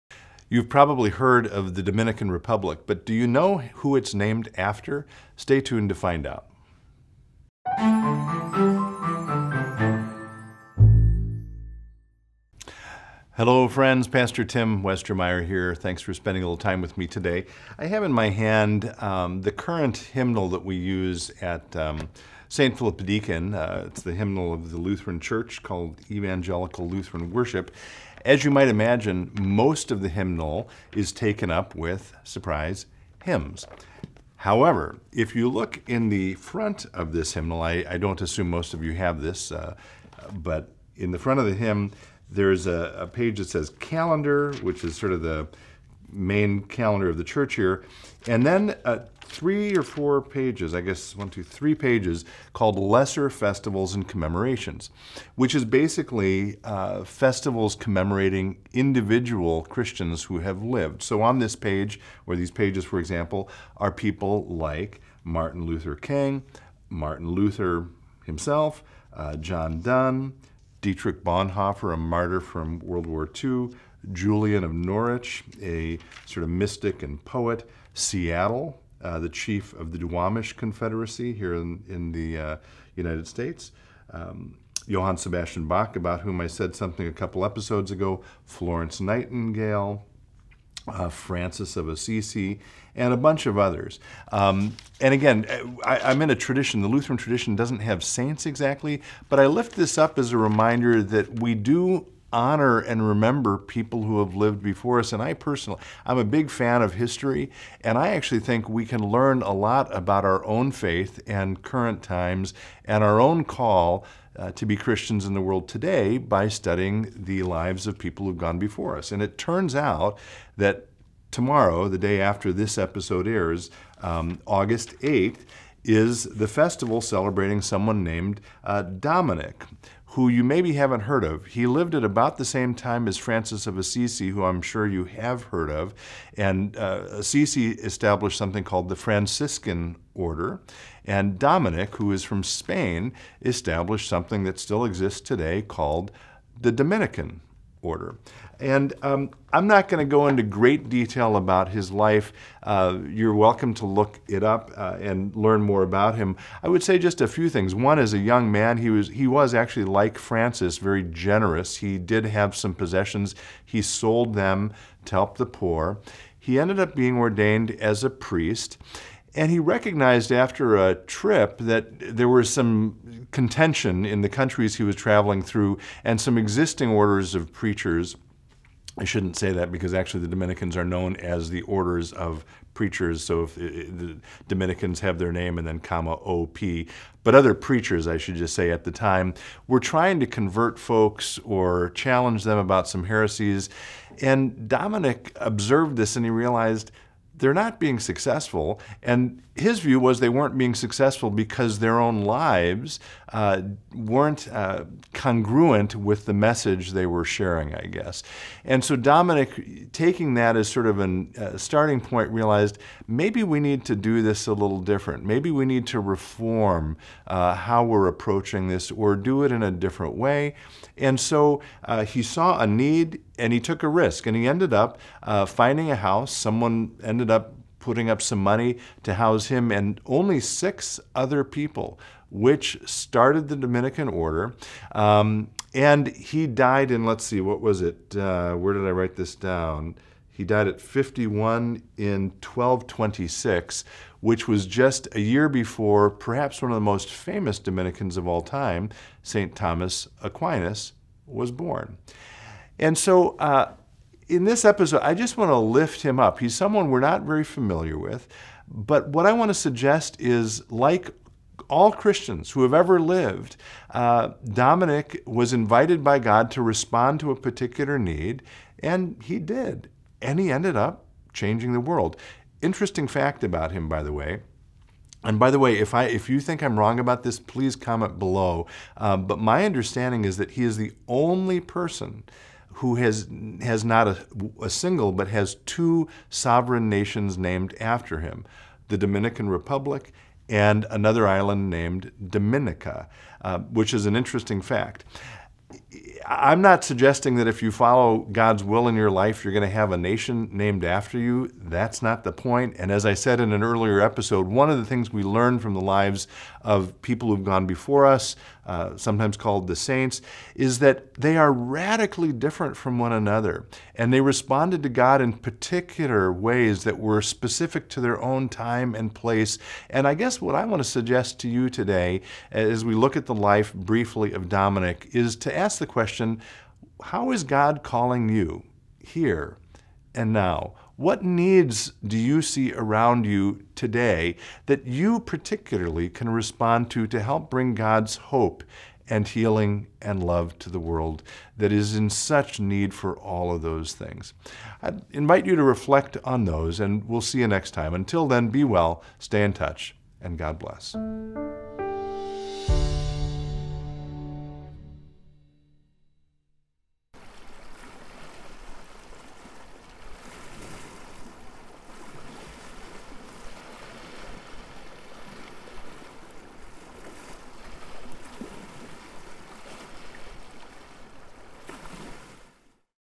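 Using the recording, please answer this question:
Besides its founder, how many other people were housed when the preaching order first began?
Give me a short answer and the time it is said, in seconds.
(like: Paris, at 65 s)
6, at 230 s.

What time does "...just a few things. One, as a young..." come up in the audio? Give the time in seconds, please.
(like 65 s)
156 s.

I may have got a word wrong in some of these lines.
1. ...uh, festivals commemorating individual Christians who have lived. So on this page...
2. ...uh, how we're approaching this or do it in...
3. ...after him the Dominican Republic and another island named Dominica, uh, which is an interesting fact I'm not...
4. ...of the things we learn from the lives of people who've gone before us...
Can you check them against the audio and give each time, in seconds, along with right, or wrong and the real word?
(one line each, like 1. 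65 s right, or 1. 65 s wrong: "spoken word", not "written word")
1. 56 s right
2. 217 s right
3. 287 s right
4. 304 s right.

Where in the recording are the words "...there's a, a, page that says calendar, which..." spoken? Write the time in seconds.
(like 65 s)
42 s.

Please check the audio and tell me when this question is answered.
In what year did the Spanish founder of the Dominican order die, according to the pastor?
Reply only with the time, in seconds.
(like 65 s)
242 s.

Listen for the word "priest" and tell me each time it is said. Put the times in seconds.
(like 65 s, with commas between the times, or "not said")
168 s.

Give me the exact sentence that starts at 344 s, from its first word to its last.
I invite you to reflect on those, and we'll see you next time.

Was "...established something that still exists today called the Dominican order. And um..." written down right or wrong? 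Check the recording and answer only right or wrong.
right.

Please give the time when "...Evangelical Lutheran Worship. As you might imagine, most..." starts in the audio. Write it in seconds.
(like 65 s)
26 s.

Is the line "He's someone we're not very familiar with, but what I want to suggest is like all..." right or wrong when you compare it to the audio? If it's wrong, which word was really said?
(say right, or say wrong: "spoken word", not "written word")
right.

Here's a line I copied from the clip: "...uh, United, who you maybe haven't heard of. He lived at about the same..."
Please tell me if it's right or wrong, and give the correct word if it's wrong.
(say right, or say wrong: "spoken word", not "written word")
wrong: "Dominic", not "United".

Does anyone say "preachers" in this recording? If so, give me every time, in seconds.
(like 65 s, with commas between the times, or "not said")
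177 s, 182 s, 187 s.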